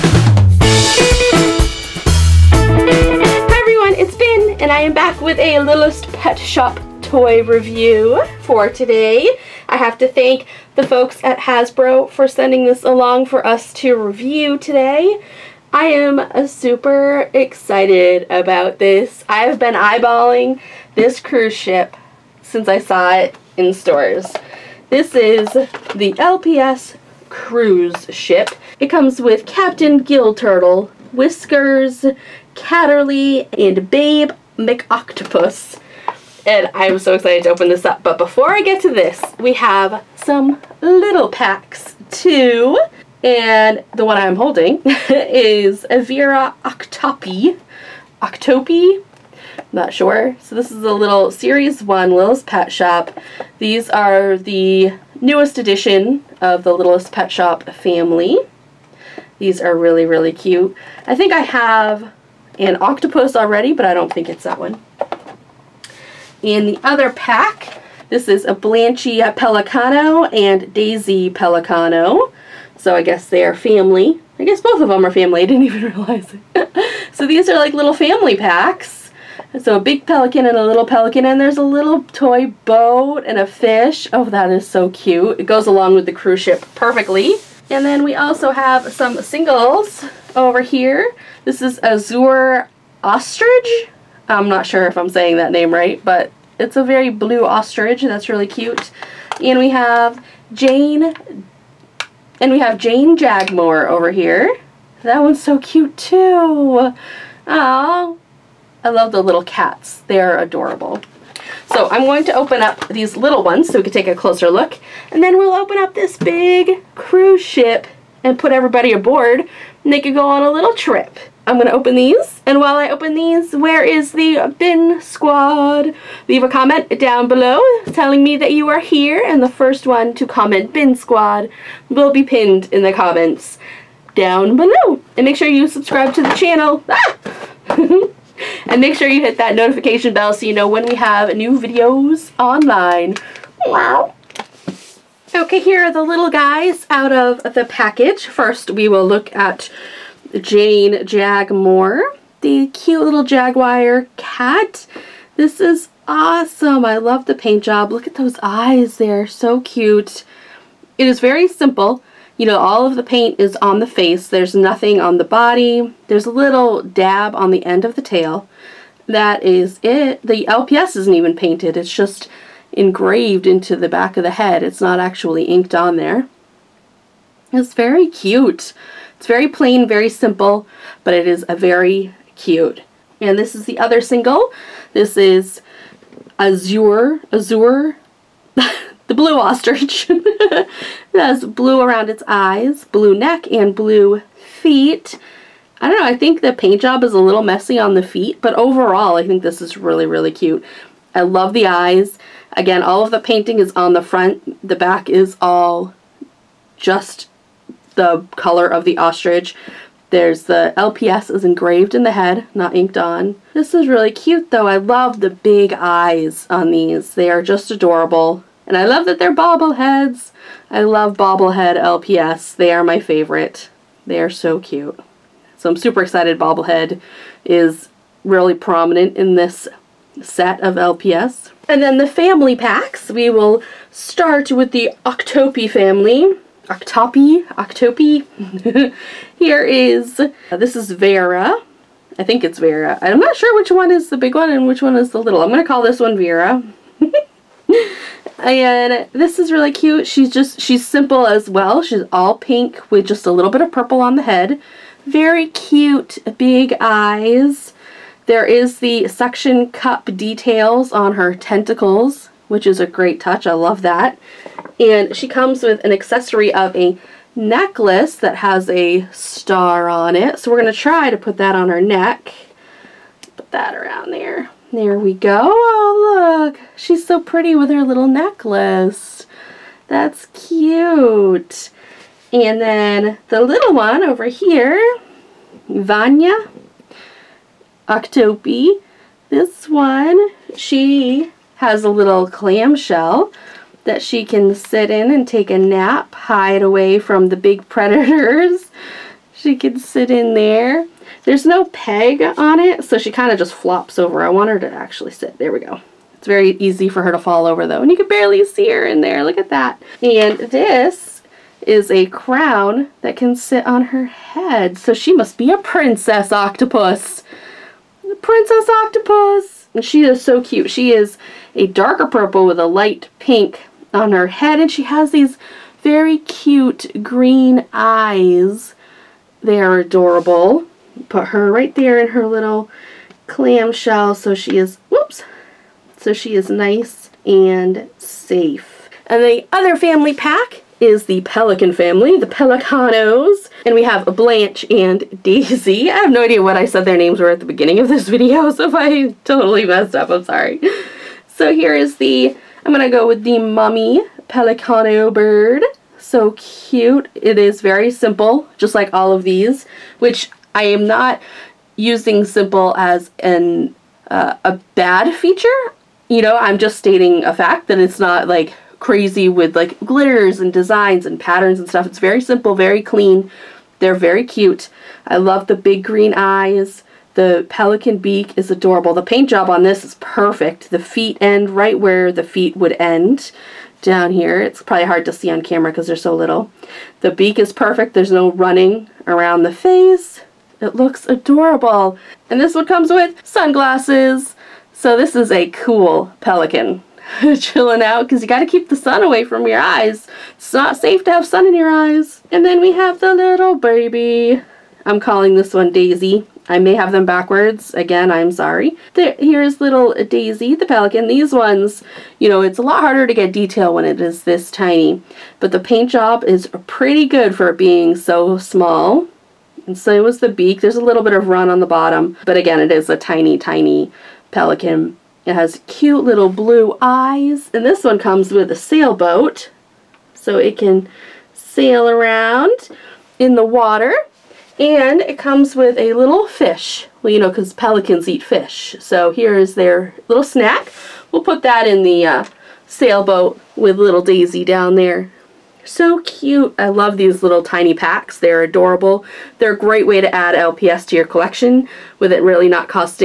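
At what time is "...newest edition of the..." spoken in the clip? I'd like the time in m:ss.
0:55.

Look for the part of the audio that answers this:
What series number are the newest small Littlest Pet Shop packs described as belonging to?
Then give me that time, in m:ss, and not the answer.
0:51.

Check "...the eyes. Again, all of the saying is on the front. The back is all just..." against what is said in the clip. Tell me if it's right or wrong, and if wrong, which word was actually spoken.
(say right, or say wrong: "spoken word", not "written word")
wrong: "painting", not "saying".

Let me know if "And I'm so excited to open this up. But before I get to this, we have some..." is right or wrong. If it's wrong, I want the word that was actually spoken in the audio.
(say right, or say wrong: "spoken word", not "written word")
right.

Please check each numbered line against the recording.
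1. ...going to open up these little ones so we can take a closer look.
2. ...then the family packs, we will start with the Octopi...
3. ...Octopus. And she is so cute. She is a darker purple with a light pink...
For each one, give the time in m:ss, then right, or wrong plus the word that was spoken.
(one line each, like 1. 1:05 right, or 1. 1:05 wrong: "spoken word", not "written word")
1. 1:52 right
2. 3:51 right
3. 5:18 right.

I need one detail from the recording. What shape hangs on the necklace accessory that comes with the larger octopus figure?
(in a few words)
a star.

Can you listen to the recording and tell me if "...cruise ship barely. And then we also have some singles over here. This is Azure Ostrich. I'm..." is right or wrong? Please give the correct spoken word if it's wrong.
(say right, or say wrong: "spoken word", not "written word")
wrong: "perfectly", not "barely".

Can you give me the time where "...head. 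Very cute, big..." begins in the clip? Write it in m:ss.
4:14.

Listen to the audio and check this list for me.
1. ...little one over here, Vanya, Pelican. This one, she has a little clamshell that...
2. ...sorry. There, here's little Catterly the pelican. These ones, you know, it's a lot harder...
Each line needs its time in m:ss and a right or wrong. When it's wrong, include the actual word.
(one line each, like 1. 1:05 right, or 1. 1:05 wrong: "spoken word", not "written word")
1. 4:43 wrong: "Octopi", not "Pelican"
2. 6:48 wrong: "Daisy", not "Catterly".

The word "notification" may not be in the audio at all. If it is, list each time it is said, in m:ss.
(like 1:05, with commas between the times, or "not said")
2:19.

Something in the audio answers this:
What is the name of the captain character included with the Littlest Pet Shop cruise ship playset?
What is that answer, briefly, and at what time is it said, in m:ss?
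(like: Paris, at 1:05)
Captain Gill Turtle, at 0:29.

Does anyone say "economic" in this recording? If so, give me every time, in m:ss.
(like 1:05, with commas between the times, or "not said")
not said.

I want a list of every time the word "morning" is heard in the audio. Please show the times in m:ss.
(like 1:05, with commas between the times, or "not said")
not said.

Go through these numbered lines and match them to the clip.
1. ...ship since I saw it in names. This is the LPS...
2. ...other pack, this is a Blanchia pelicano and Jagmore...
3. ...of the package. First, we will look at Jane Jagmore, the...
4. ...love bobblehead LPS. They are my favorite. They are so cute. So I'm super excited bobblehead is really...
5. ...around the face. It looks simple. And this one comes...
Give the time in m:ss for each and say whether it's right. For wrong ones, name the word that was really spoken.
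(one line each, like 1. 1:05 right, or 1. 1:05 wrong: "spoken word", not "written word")
1. 0:21 wrong: "stores", not "names"
2. 1:06 wrong: "Daisy", not "Jagmore"
3. 2:27 right
4. 3:40 right
5. 6:29 wrong: "adorable", not "simple".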